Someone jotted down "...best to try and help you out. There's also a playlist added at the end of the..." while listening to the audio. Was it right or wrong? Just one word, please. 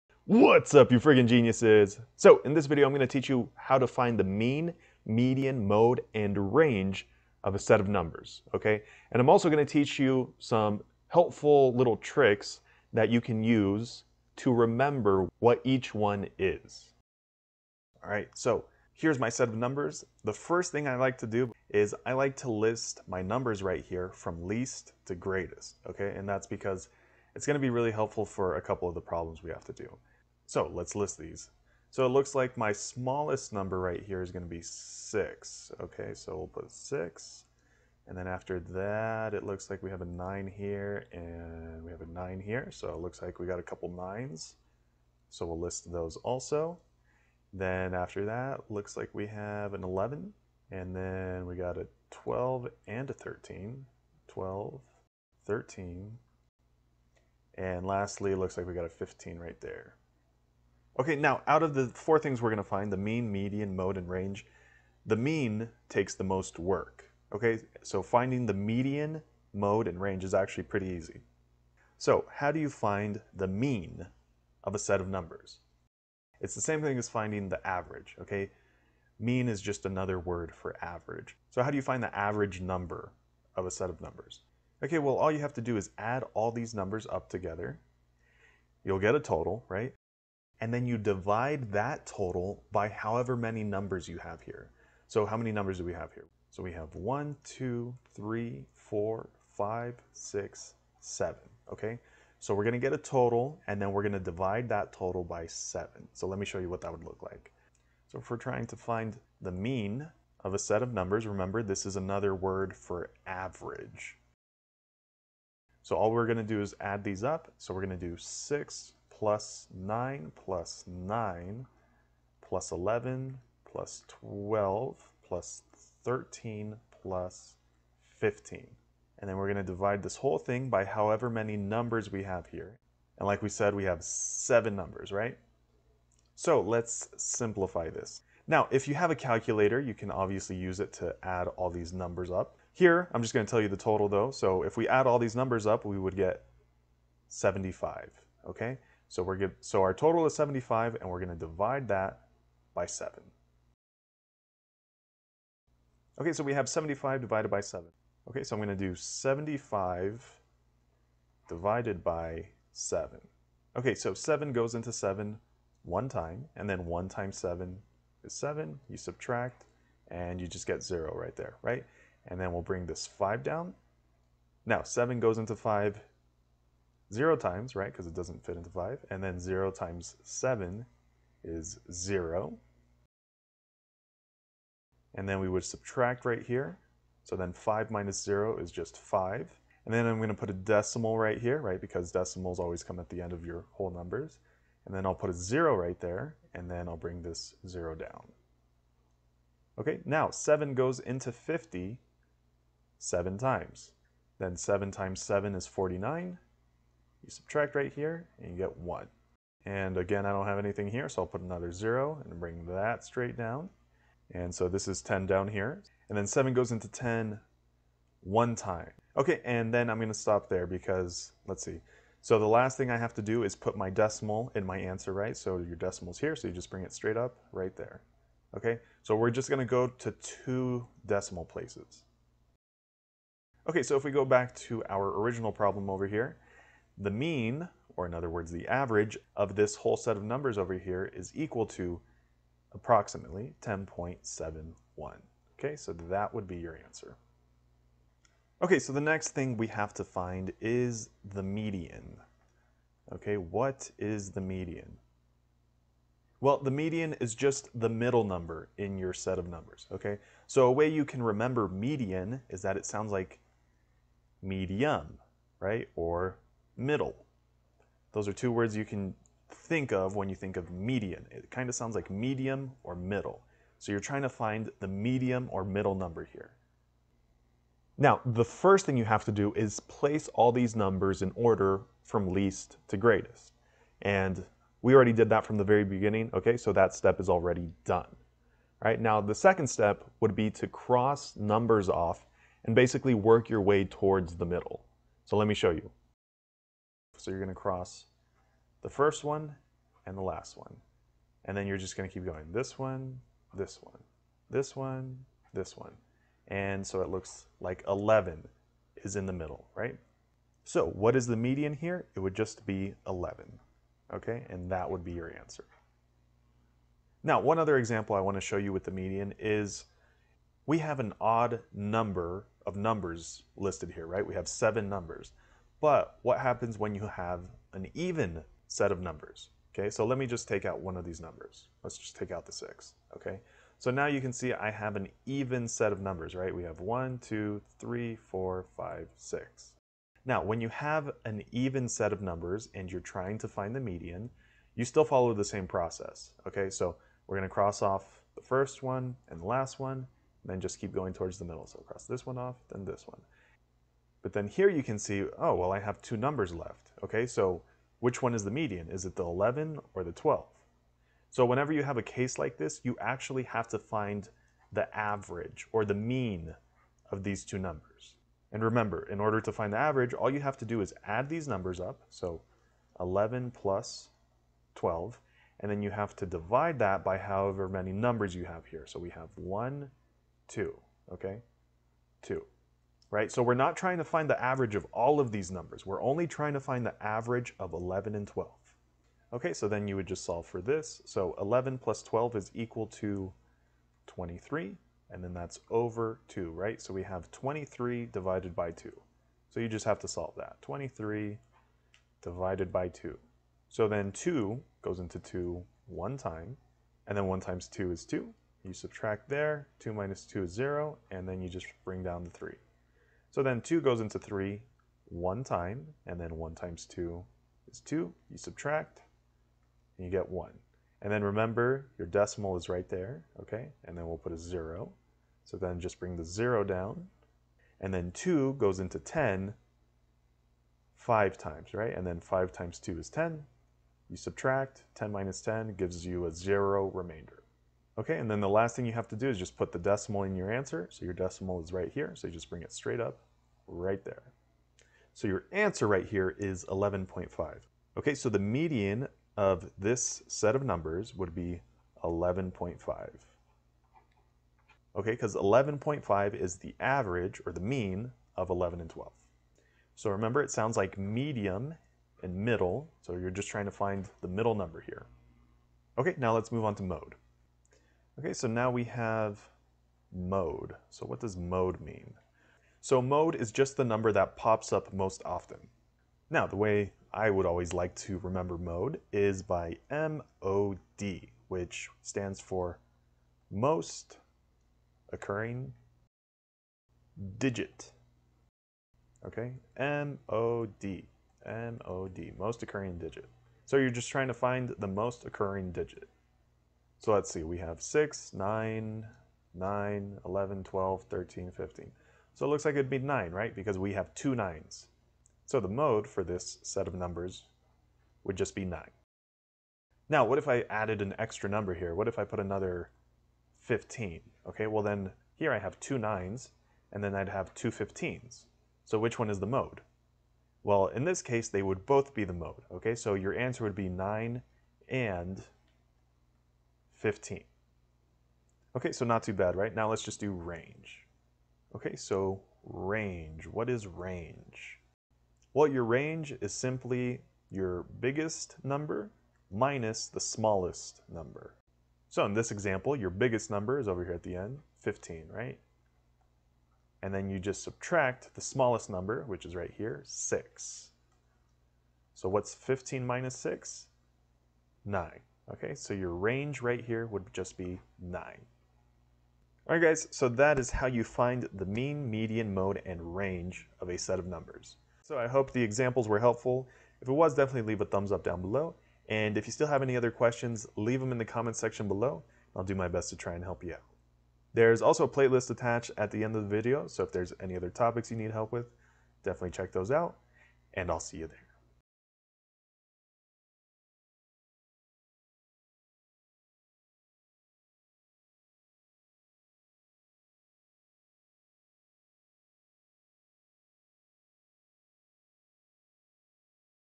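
wrong.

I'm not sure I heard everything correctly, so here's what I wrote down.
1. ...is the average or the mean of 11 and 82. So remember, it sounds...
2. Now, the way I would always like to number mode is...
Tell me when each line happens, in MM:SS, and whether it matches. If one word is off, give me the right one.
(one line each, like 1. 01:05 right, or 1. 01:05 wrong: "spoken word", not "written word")
1. 07:36 wrong: "12", not "82"
2. 07:56 wrong: "remember", not "number".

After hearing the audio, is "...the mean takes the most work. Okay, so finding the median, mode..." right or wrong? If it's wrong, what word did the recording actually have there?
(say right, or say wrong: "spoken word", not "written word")
right.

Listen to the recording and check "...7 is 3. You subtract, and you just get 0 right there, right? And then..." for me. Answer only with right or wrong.
wrong.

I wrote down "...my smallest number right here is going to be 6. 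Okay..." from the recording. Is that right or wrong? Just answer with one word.
right.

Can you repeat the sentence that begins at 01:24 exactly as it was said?
Okay, well all you have to do is add all these numbers up together.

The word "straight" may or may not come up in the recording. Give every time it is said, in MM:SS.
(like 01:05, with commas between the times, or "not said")
03:33, 03:46, 07:22.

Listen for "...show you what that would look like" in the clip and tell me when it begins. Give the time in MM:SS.
01:46.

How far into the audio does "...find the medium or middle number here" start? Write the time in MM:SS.
04:34.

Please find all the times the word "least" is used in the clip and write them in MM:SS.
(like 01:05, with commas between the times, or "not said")
00:24, 04:42.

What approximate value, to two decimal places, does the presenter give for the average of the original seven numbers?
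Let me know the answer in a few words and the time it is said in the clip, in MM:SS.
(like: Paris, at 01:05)
10.71, at 04:03.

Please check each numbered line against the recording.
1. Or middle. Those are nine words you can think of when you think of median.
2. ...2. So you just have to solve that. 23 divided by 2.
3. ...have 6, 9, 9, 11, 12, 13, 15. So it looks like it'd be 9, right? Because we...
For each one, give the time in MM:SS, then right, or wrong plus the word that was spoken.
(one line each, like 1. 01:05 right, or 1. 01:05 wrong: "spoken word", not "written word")
1. 04:25 wrong: "two", not "nine"
2. 06:38 right
3. 08:17 right.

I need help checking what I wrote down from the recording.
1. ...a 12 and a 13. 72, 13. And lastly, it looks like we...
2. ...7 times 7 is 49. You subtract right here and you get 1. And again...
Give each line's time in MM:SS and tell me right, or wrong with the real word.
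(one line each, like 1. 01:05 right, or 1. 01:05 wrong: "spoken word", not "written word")
1. 00:51 wrong: "12", not "72"
2. 03:24 right.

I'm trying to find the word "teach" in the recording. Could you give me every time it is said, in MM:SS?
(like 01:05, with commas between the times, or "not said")
00:03, 00:09.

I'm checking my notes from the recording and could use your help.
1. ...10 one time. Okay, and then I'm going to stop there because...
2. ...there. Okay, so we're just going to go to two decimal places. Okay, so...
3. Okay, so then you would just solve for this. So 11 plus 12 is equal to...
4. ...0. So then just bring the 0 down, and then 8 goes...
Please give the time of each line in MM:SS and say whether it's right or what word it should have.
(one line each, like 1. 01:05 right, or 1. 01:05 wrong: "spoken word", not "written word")
1. 03:36 right
2. 03:47 right
3. 06:29 right
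4. 07:04 wrong: "2", not "8".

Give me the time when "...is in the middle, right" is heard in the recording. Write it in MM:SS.
05:09.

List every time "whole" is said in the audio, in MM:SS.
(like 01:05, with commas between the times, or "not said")
02:10, 03:13, 03:59.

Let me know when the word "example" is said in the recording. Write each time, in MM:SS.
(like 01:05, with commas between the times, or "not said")
05:17, 09:02, 09:25.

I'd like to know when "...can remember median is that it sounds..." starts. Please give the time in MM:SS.
04:21.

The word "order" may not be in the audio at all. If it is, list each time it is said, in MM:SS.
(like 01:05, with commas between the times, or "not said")
04:41, 06:09.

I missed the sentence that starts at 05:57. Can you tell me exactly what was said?
Okay, so which one is the median?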